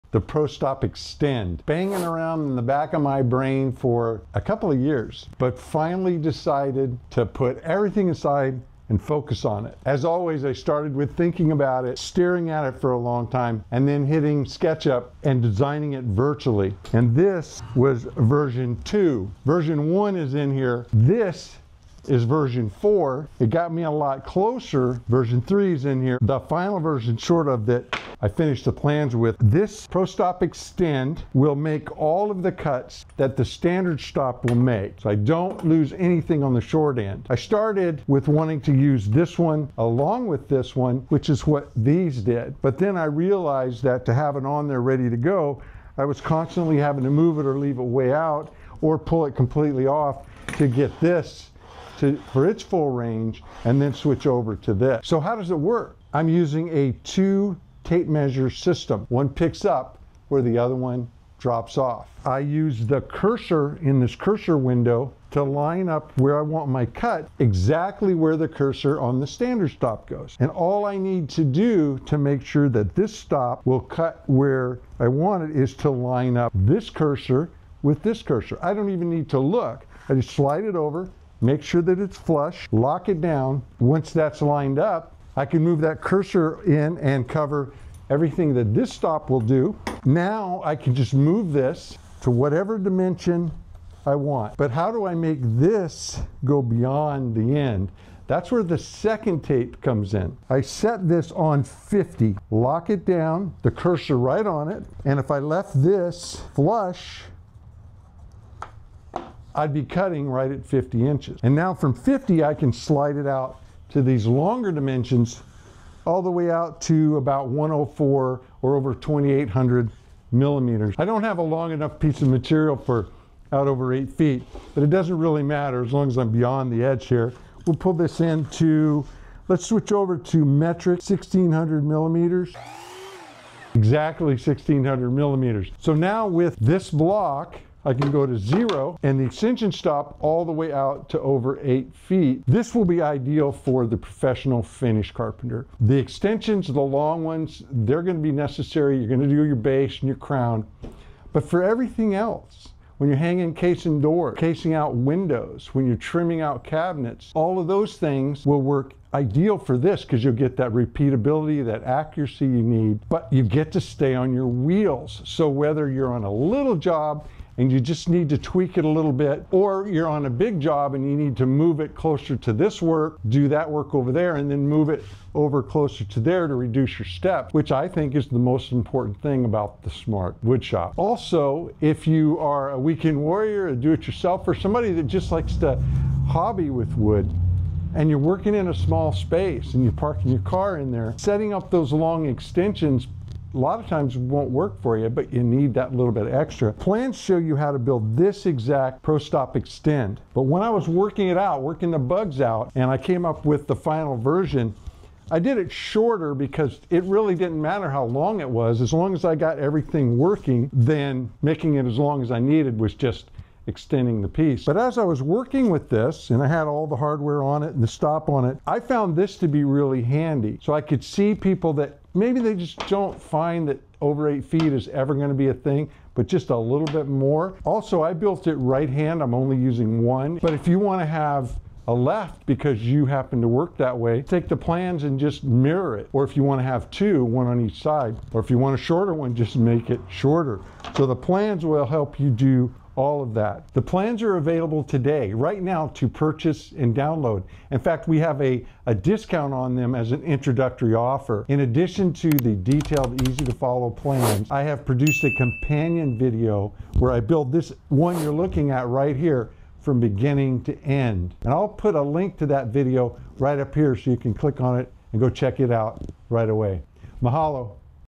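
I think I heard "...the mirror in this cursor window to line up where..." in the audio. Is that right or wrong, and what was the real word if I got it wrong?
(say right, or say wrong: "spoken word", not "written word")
wrong: "cursor", not "mirror".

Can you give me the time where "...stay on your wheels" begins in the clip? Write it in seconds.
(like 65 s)
163 s.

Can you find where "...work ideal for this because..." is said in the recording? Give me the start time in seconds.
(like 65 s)
158 s.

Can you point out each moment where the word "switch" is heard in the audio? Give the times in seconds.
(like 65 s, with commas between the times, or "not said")
53 s, 129 s.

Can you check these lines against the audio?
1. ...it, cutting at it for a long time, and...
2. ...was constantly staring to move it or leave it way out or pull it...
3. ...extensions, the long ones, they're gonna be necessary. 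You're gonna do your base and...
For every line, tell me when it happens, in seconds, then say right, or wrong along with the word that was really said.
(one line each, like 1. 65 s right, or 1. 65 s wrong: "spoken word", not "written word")
1. 11 s wrong: "staring", not "cutting"
2. 46 s wrong: "having", not "staring"
3. 145 s right.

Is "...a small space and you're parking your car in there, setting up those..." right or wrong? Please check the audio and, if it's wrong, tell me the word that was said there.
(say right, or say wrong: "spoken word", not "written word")
right.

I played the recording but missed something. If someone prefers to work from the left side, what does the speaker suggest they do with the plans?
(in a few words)
Mirror it.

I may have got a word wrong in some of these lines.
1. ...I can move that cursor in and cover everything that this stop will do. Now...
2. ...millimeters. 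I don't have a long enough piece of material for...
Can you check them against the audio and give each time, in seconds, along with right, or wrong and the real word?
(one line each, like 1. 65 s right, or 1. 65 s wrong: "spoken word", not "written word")
1. 85 s right
2. 120 s right.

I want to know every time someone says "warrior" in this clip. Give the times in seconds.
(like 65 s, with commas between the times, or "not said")
183 s.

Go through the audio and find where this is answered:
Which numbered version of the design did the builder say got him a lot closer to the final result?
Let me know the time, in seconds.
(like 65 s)
22 s.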